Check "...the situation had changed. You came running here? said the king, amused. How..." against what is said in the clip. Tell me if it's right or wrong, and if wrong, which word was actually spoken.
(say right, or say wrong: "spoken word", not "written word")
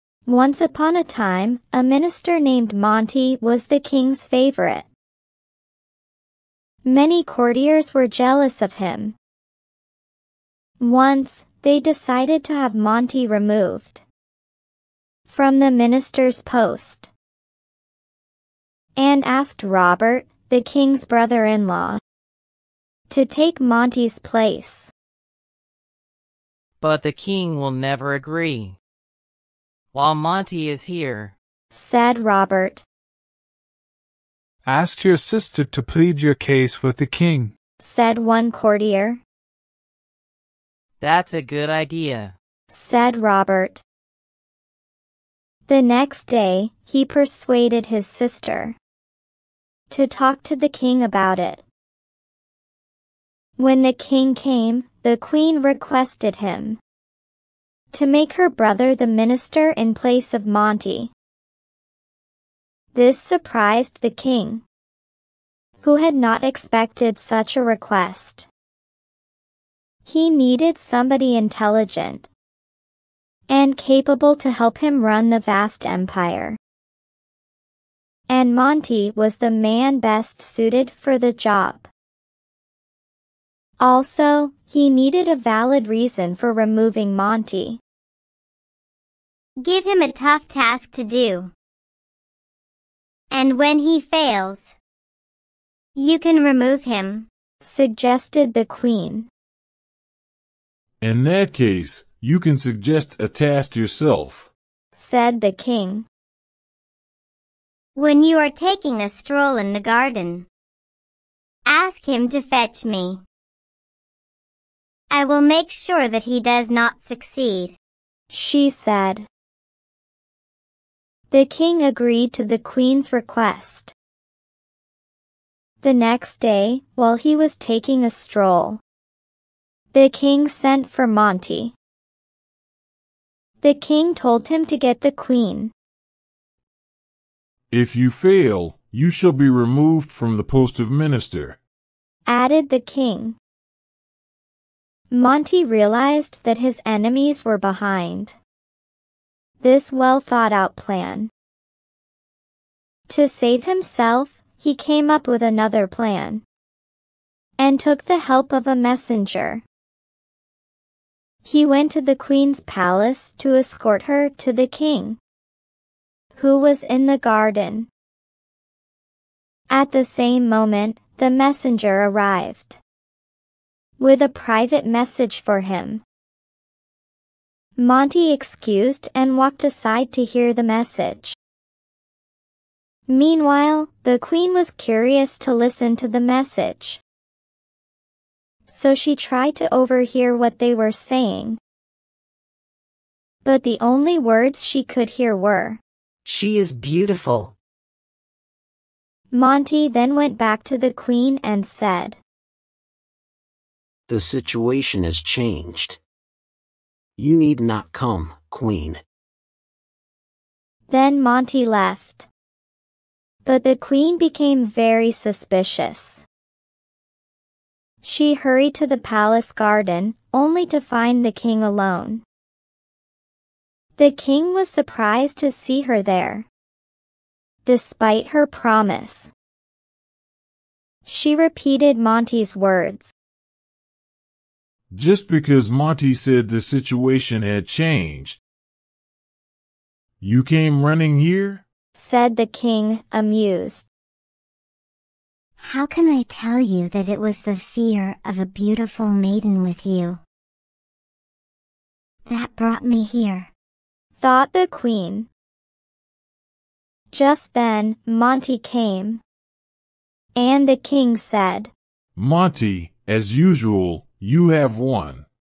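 right.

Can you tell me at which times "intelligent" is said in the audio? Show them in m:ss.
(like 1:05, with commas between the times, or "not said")
1:11.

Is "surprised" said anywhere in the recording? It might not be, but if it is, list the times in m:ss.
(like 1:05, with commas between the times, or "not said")
1:03, 3:44.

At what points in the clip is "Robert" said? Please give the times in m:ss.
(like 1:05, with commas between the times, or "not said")
0:19, 0:32, 0:43.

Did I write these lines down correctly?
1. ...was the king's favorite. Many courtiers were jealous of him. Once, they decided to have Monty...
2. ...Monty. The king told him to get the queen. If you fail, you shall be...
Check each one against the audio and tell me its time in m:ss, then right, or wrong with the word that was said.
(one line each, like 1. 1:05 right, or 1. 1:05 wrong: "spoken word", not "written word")
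1. 0:03 right
2. 2:11 right.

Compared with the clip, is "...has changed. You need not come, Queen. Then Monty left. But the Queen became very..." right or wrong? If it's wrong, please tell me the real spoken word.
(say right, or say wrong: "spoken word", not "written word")
right.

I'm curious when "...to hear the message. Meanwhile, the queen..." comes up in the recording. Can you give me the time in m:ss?
3:00.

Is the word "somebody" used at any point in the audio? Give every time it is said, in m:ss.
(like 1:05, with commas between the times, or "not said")
1:10.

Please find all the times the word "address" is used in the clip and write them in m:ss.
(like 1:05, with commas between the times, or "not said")
not said.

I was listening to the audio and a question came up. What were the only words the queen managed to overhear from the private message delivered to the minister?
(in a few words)
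She is beautiful.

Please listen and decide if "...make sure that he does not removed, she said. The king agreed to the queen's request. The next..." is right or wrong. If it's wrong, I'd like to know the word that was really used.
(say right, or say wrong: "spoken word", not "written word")
wrong: "succeed", not "removed".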